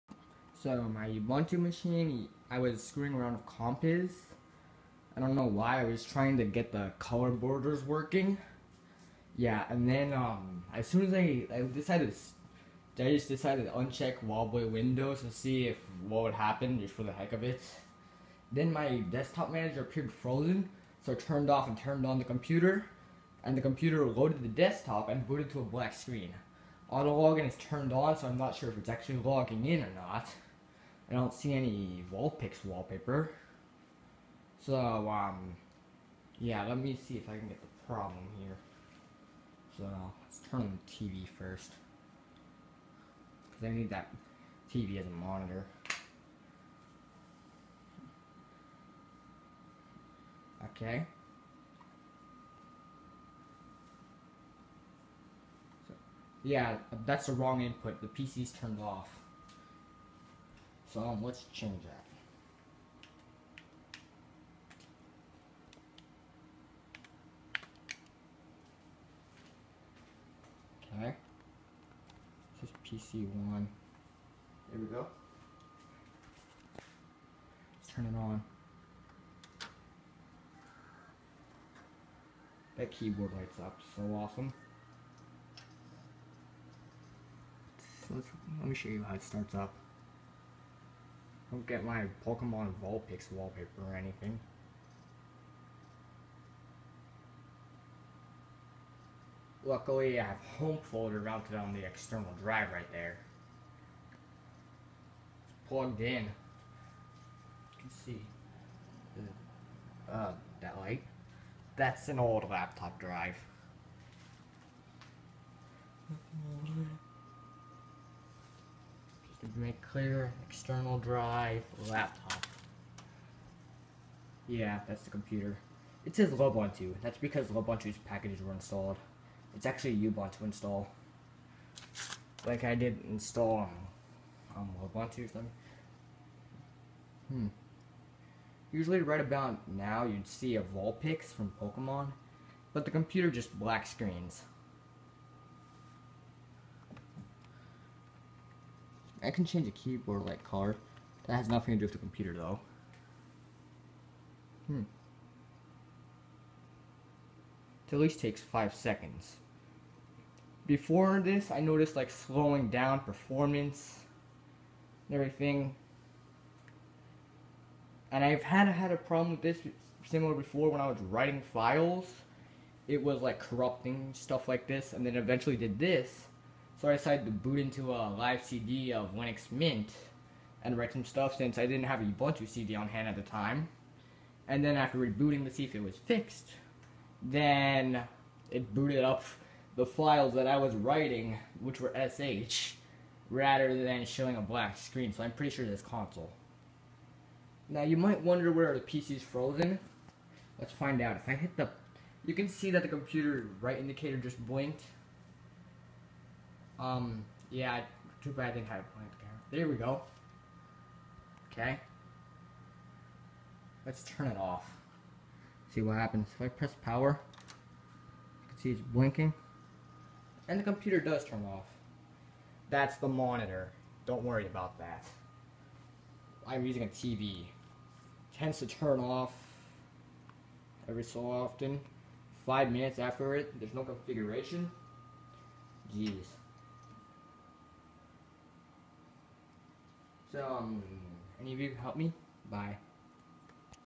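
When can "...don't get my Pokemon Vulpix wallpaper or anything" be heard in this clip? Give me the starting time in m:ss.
1:31.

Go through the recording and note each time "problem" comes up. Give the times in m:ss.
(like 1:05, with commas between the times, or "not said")
0:37, 2:48.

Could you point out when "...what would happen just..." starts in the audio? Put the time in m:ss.
0:16.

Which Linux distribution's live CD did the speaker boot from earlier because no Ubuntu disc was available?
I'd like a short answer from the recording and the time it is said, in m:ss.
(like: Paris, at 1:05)
Linux Mint, at 2:59.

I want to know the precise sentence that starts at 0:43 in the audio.
Because I need that TV as a monitor.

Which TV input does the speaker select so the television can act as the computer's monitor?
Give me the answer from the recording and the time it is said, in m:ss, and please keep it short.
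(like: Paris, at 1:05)
PC1, at 1:13.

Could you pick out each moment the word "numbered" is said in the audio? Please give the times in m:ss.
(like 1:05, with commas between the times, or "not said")
not said.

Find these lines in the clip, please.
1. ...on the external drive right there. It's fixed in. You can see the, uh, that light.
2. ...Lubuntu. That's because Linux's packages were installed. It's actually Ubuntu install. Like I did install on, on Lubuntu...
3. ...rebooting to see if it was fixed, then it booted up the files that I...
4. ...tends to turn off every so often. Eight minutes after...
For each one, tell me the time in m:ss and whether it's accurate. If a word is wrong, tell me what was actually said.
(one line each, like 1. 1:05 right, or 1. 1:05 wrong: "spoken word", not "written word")
1. 1:41 wrong: "plugged", not "fixed"
2. 2:06 wrong: "Lubuntu", not "Linux"
3. 3:04 right
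4. 3:48 wrong: "Five", not "Eight".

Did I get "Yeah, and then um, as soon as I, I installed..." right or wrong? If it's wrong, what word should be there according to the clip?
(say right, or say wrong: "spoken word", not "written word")
wrong: "decided", not "installed".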